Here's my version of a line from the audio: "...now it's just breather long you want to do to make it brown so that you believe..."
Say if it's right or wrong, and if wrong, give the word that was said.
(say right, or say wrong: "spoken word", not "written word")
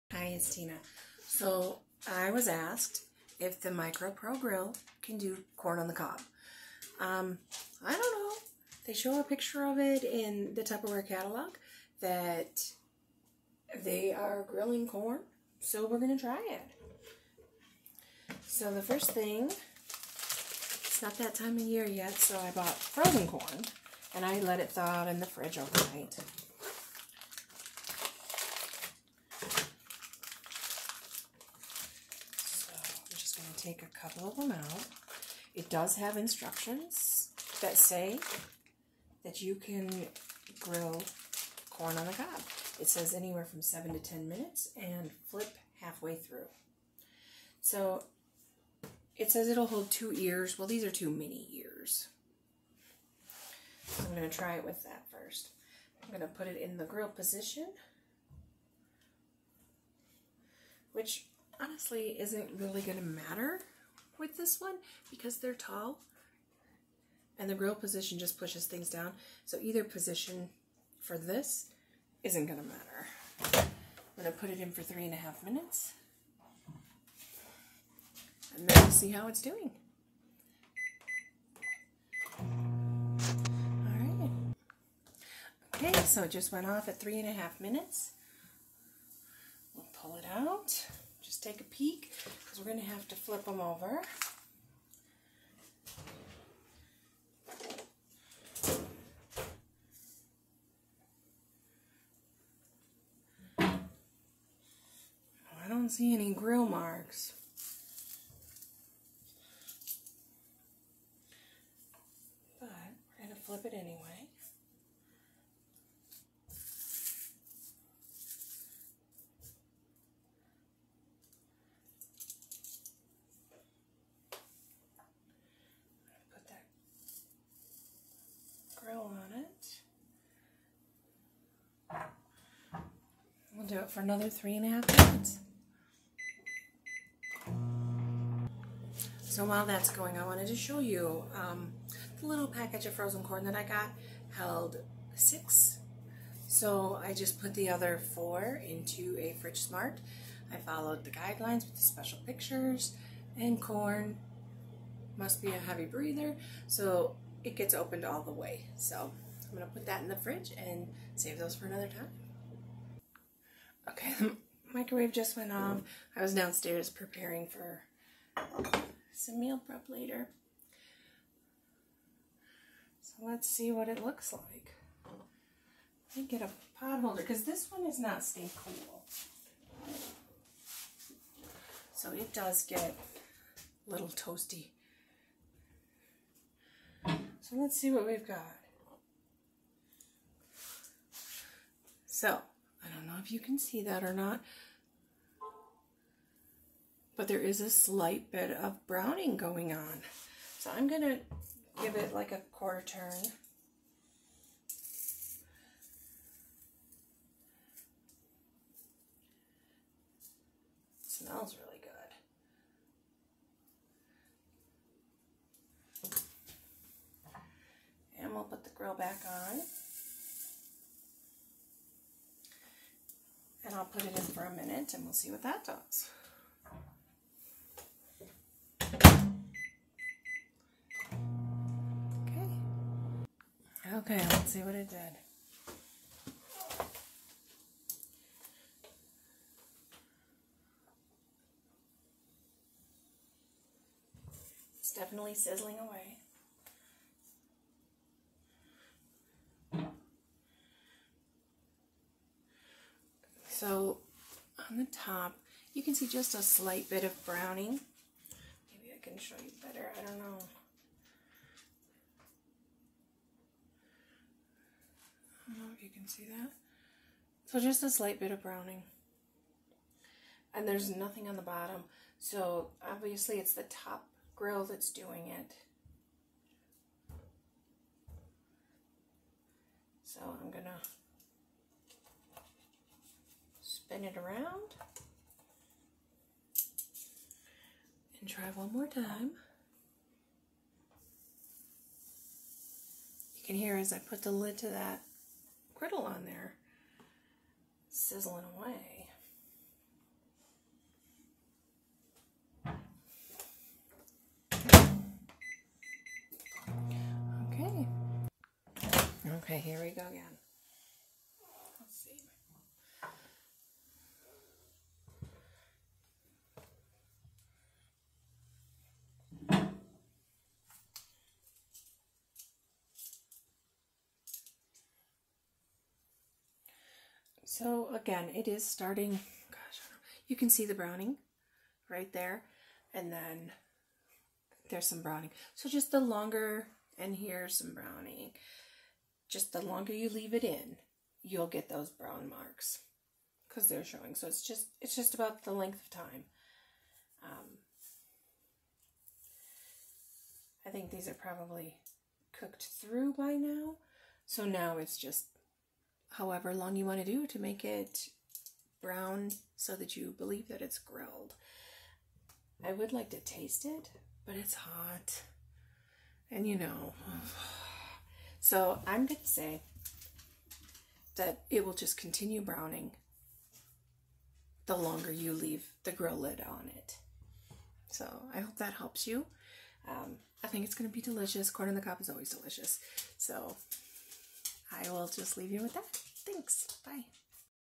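wrong: "however", not "breather".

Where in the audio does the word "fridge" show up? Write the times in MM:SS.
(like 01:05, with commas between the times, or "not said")
00:25, 02:29, 02:40.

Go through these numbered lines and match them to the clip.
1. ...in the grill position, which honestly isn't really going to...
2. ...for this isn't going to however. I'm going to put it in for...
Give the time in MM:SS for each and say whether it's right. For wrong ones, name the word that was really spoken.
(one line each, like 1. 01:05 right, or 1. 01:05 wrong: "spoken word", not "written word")
1. 00:56 right
2. 01:11 wrong: "matter", not "however".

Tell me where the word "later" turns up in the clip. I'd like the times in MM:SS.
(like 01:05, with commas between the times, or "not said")
02:49.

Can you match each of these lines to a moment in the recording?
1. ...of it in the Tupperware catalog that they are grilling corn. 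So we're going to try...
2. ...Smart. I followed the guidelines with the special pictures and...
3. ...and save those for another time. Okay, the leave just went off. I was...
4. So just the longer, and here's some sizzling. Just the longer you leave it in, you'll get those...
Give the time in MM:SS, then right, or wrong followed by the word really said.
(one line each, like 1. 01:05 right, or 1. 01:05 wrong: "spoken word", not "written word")
1. 00:09 right
2. 02:29 right
3. 02:40 wrong: "microwave", not "leave"
4. 05:35 wrong: "browning", not "sizzling".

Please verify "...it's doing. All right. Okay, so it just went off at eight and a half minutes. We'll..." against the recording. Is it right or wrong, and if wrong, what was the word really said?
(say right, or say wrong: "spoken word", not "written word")
wrong: "three", not "eight".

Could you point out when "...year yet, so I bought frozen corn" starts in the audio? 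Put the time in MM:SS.
00:21.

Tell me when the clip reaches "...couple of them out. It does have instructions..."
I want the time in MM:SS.
00:33.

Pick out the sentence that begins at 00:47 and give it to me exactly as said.
So it says it'll hold two ears.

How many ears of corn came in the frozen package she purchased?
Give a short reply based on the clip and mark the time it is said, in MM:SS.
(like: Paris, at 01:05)
6, at 02:25.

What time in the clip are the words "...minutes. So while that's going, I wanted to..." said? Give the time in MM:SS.
02:15.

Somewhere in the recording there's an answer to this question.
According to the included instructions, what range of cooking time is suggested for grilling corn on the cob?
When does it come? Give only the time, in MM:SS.
00:43.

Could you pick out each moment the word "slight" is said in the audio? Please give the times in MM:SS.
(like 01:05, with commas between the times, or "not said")
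03:17, 04:16, 04:27.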